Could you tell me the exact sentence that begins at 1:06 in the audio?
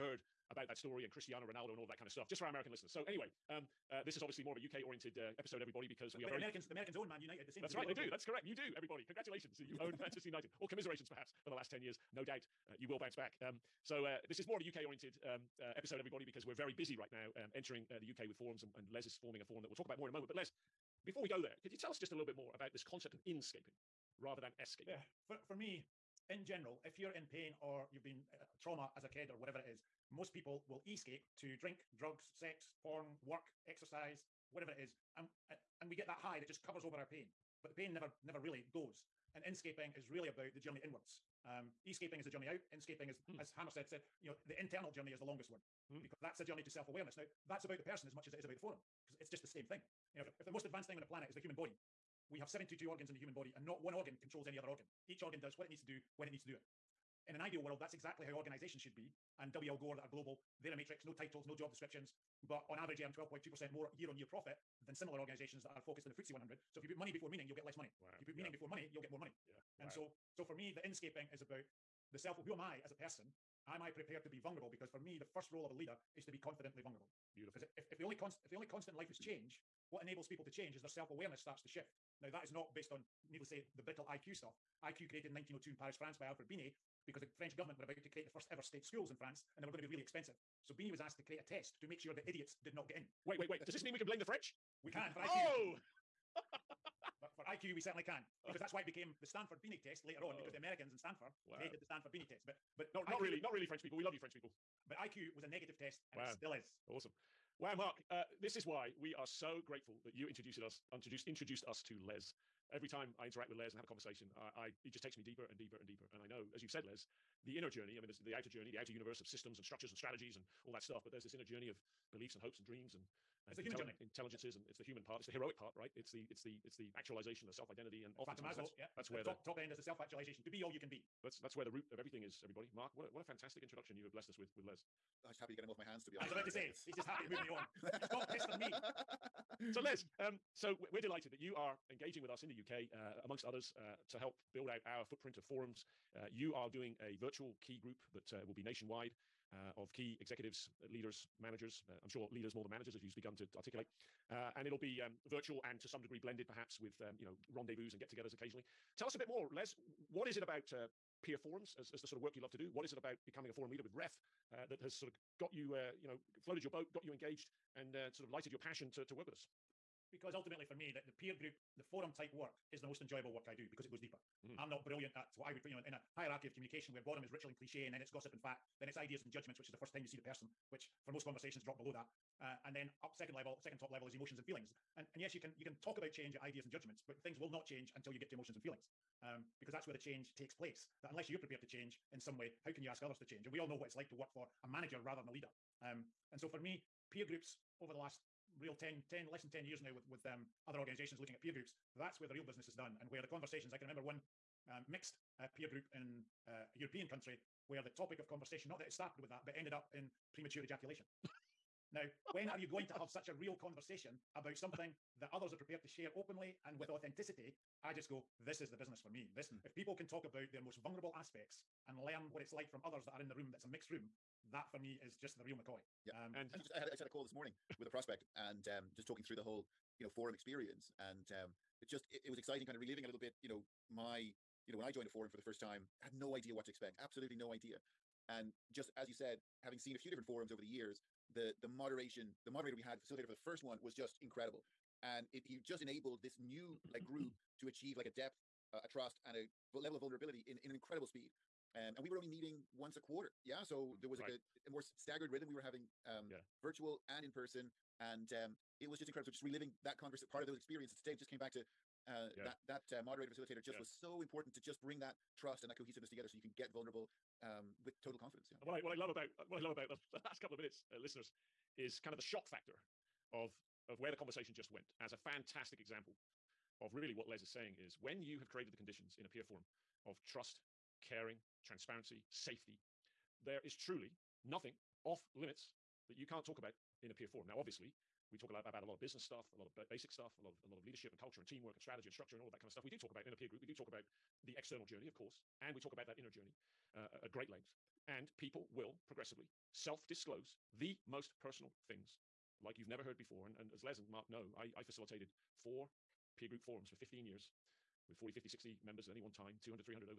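So if you put money before meaning, you'll get less money.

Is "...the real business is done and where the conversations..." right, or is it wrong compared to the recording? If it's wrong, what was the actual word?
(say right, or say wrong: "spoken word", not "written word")
right.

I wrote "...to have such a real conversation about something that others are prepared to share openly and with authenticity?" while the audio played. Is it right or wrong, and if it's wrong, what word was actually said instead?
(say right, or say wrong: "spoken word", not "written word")
right.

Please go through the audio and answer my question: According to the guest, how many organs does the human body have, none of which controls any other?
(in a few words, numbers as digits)
72.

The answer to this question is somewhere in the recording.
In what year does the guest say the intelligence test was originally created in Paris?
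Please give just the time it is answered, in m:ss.
1:25.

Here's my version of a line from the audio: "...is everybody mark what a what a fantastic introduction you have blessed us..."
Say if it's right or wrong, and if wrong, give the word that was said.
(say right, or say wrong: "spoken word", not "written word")
right.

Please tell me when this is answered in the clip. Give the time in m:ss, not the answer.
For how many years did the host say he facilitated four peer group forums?
5:06.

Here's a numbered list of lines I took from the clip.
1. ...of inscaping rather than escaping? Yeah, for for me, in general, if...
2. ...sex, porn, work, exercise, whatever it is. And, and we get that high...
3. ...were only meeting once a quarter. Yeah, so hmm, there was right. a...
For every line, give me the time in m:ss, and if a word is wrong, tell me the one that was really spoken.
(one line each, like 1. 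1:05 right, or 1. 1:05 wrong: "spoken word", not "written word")
1. 0:23 right
2. 0:32 right
3. 4:12 right.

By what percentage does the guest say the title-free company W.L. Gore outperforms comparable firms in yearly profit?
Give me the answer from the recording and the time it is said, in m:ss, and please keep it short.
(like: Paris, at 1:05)
12.2%, at 1:03.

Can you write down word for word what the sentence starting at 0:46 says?
because that's a journey to self awareness.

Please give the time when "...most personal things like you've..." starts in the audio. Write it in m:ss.
5:01.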